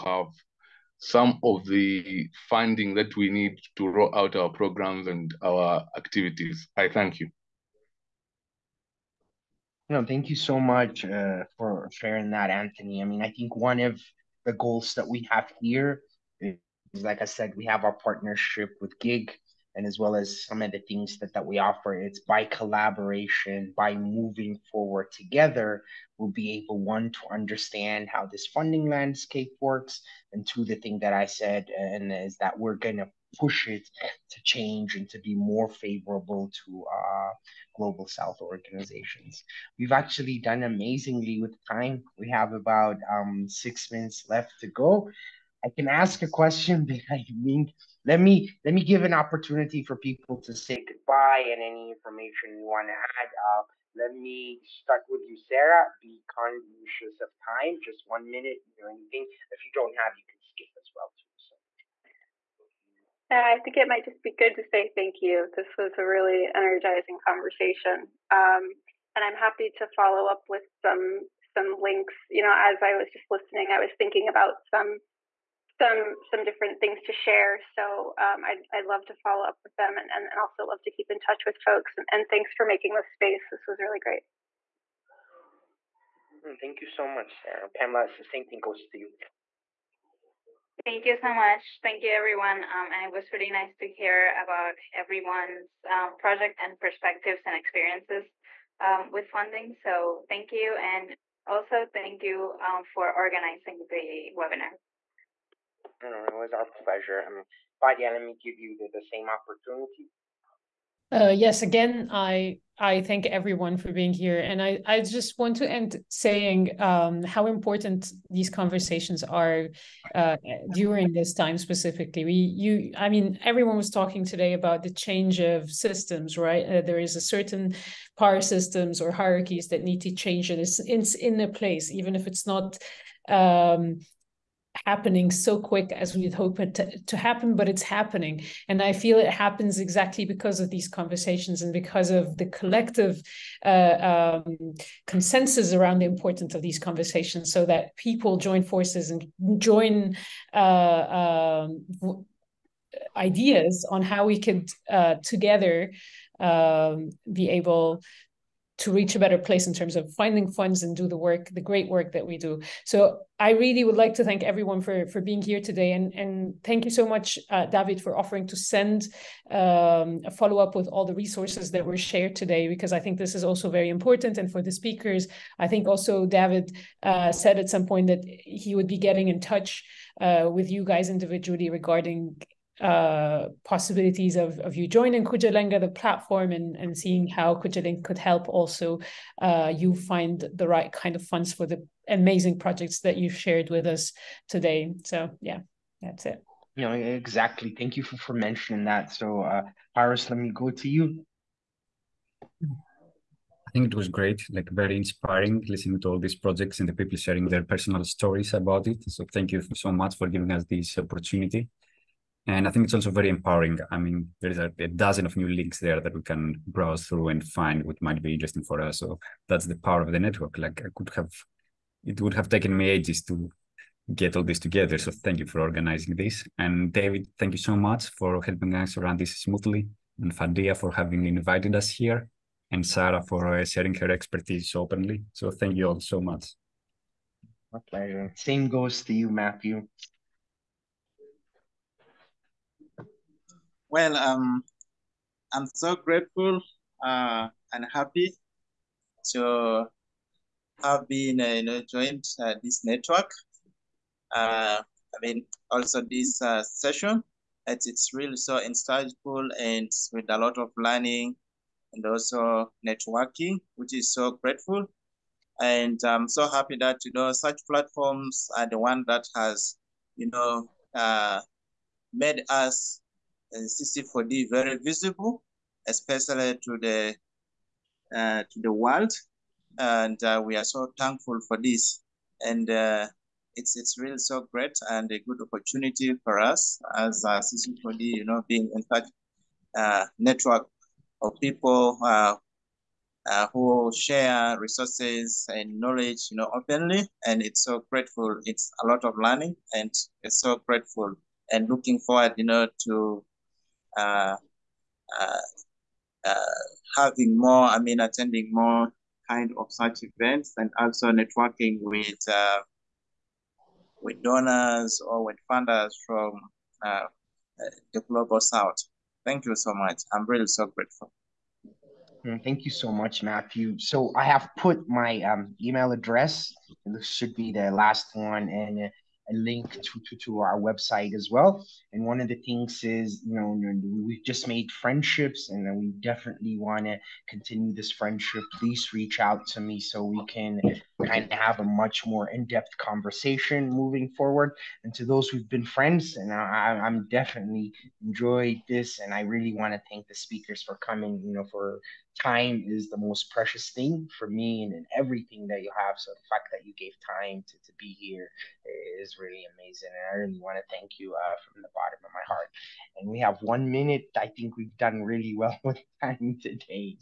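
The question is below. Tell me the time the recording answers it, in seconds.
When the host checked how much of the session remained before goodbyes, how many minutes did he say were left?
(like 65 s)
43 s.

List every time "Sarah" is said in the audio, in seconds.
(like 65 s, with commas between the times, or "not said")
55 s, 87 s, 232 s.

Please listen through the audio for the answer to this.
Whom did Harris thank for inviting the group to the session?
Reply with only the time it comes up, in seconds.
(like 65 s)
230 s.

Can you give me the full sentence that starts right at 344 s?
And to those who've been friends, and I, I'm definitely enjoyed this.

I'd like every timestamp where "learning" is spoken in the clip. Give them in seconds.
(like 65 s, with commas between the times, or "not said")
260 s, 299 s.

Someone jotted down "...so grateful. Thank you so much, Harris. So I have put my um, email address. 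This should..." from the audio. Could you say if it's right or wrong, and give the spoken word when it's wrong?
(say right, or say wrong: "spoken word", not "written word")
wrong: "Matthew", not "Harris".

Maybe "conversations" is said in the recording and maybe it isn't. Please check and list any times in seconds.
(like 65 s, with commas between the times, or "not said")
67 s, 118 s, 140 s, 146 s, 342 s.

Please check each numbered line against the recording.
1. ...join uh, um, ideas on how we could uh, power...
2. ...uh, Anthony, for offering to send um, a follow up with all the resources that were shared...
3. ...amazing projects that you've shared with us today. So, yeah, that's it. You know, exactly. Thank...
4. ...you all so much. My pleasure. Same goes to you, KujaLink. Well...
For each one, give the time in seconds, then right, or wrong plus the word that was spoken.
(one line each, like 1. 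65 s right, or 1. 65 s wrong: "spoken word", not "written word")
1. 149 s wrong: "together", not "power"
2. 167 s wrong: "David", not "Anthony"
3. 192 s right
4. 235 s wrong: "Matthew", not "KujaLink".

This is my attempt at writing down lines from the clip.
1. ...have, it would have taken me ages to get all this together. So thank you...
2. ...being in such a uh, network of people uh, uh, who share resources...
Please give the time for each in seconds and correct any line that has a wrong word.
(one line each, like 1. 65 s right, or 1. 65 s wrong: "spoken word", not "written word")
1. 221 s right
2. 288 s right.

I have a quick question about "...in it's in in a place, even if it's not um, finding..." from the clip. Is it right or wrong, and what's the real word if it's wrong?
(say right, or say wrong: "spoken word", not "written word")
wrong: "happening", not "finding".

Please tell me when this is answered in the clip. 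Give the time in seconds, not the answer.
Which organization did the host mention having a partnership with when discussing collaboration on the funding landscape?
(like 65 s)
18 s.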